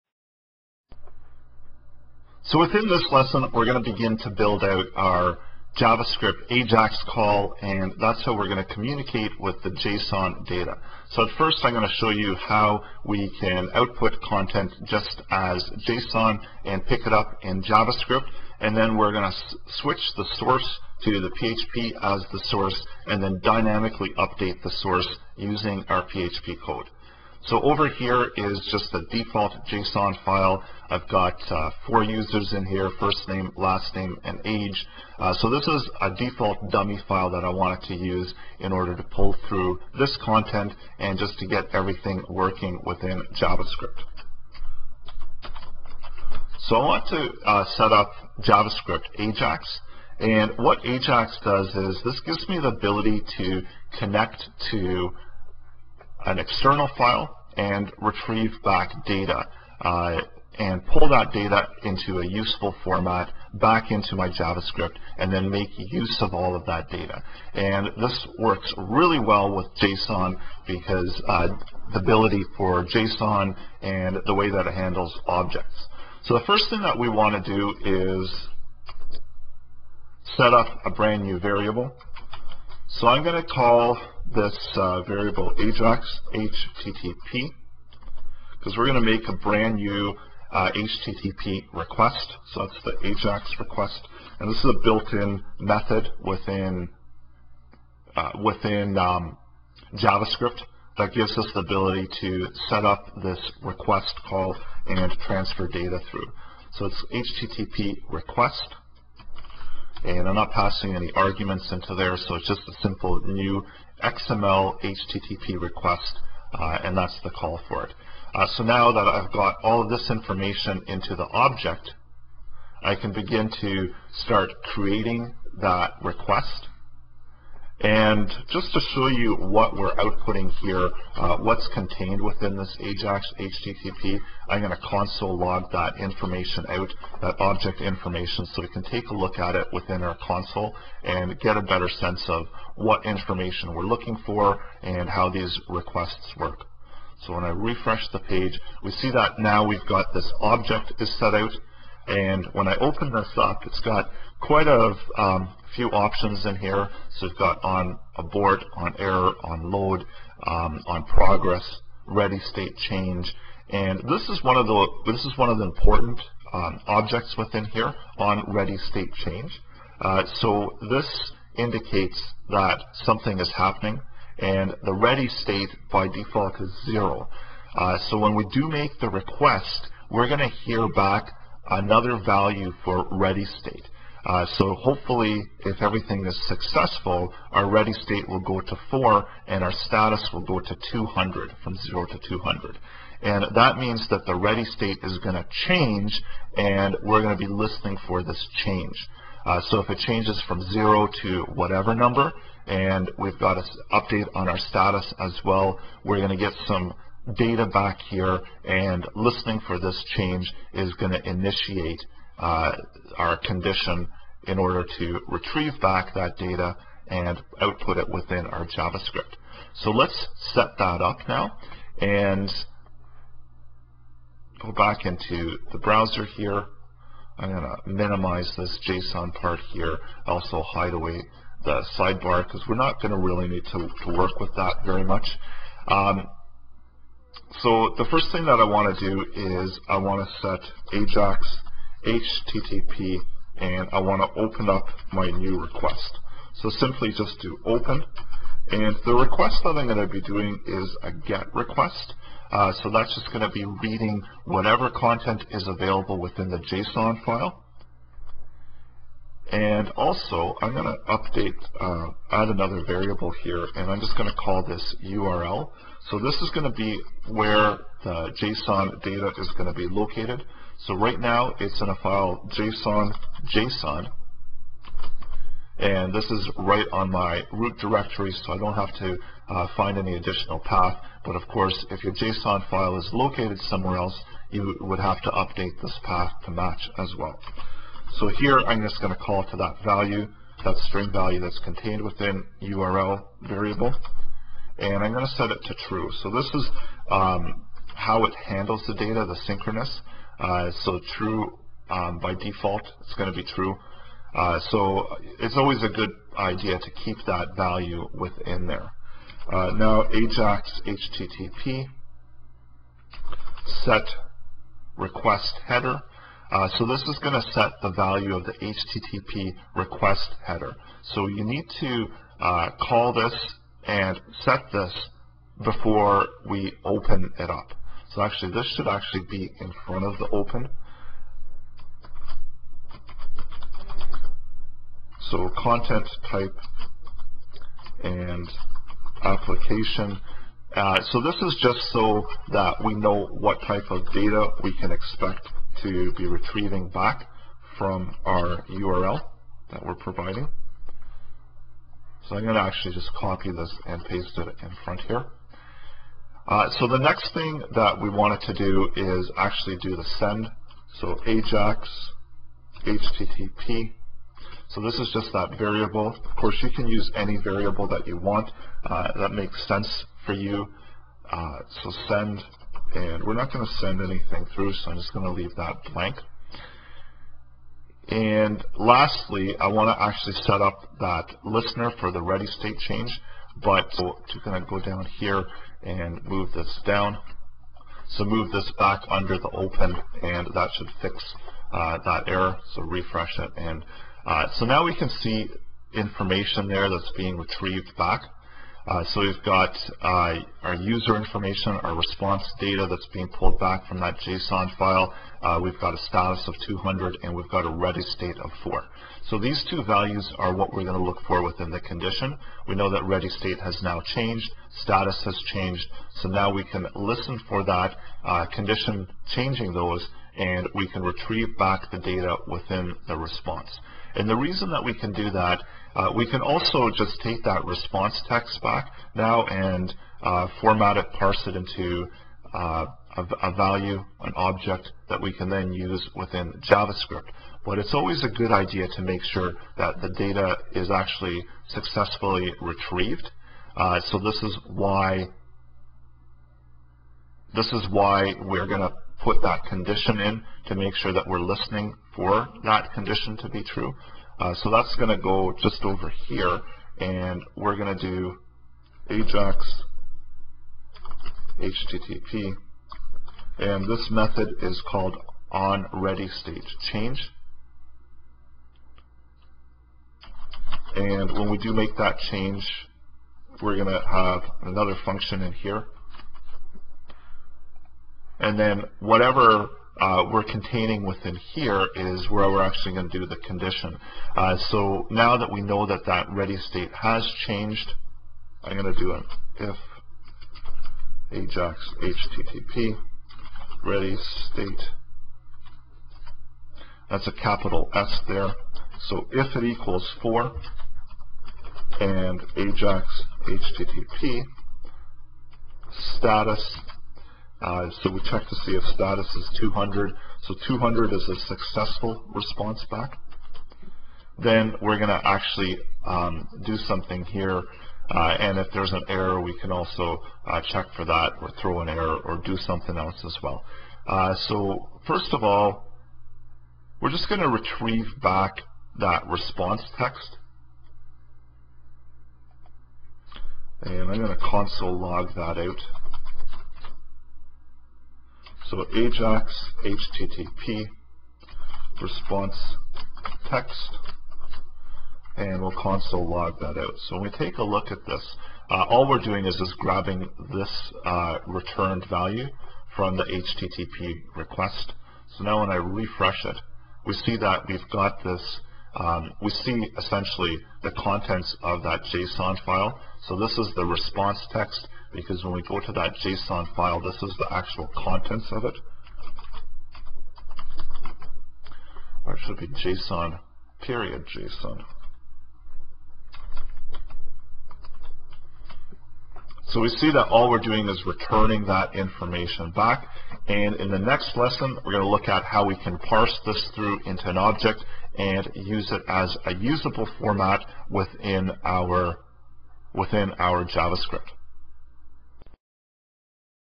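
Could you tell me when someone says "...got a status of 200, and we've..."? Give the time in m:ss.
6:45.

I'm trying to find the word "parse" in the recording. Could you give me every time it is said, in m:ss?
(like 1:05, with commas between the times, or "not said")
7:11, 9:45.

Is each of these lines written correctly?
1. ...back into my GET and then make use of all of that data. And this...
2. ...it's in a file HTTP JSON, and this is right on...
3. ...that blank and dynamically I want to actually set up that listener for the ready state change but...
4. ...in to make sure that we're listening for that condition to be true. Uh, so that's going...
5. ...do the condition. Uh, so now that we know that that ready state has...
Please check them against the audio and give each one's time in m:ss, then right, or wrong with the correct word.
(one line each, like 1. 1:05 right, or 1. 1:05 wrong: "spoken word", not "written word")
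1. 1:03 wrong: "JavaScript", not "GET"
2. 4:31 wrong: "JSON", not "HTTP"
3. 6:15 wrong: "lastly", not "dynamically"
4. 7:30 right
5. 8:03 right.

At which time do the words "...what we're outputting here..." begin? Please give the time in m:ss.
2:09.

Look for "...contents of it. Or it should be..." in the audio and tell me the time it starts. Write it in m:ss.
9:27.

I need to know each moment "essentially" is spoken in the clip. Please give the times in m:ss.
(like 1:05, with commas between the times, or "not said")
9:19.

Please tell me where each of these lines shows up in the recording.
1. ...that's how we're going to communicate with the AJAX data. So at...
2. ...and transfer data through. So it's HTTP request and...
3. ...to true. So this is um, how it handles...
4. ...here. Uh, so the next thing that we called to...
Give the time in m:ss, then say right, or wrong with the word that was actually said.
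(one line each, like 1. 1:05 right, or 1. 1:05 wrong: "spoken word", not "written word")
1. 0:07 wrong: "JSON", not "AJAX"
2. 1:44 right
3. 4:55 right
4. 5:55 wrong: "wanted", not "called".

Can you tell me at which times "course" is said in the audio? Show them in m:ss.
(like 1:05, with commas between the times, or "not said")
4:41, 6:06.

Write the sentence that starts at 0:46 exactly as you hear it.
So I want to uh, set up JavaScript Ajax.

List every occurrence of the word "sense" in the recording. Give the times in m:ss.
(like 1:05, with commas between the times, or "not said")
2:21, 6:09.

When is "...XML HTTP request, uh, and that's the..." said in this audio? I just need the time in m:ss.
1:54.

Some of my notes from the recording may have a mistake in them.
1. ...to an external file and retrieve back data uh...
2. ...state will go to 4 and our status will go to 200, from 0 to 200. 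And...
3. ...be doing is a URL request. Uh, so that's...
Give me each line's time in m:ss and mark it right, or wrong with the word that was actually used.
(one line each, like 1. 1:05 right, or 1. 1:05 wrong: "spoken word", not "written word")
1. 0:54 right
2. 3:07 right
3. 4:10 wrong: "GET", not "URL".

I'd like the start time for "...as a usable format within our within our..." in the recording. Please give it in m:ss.
9:49.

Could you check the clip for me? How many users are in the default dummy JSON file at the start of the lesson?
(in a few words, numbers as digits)
4.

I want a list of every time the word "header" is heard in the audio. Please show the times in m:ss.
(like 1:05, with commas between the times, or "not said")
5:15, 5:20.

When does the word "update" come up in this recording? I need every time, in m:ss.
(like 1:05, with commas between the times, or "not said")
0:24, 3:23, 4:21, 4:45.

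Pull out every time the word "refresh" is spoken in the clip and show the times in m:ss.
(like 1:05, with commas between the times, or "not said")
2:27, 6:32, 9:15.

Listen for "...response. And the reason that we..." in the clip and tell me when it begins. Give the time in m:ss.
7:03.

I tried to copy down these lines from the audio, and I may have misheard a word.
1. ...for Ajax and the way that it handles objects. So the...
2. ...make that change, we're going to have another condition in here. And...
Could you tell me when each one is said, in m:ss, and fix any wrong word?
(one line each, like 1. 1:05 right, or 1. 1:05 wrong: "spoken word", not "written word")
1. 1:12 wrong: "JSON", not "Ajax"
2. 7:51 wrong: "function", not "condition".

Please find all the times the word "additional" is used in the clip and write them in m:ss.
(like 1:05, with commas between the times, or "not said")
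4:40.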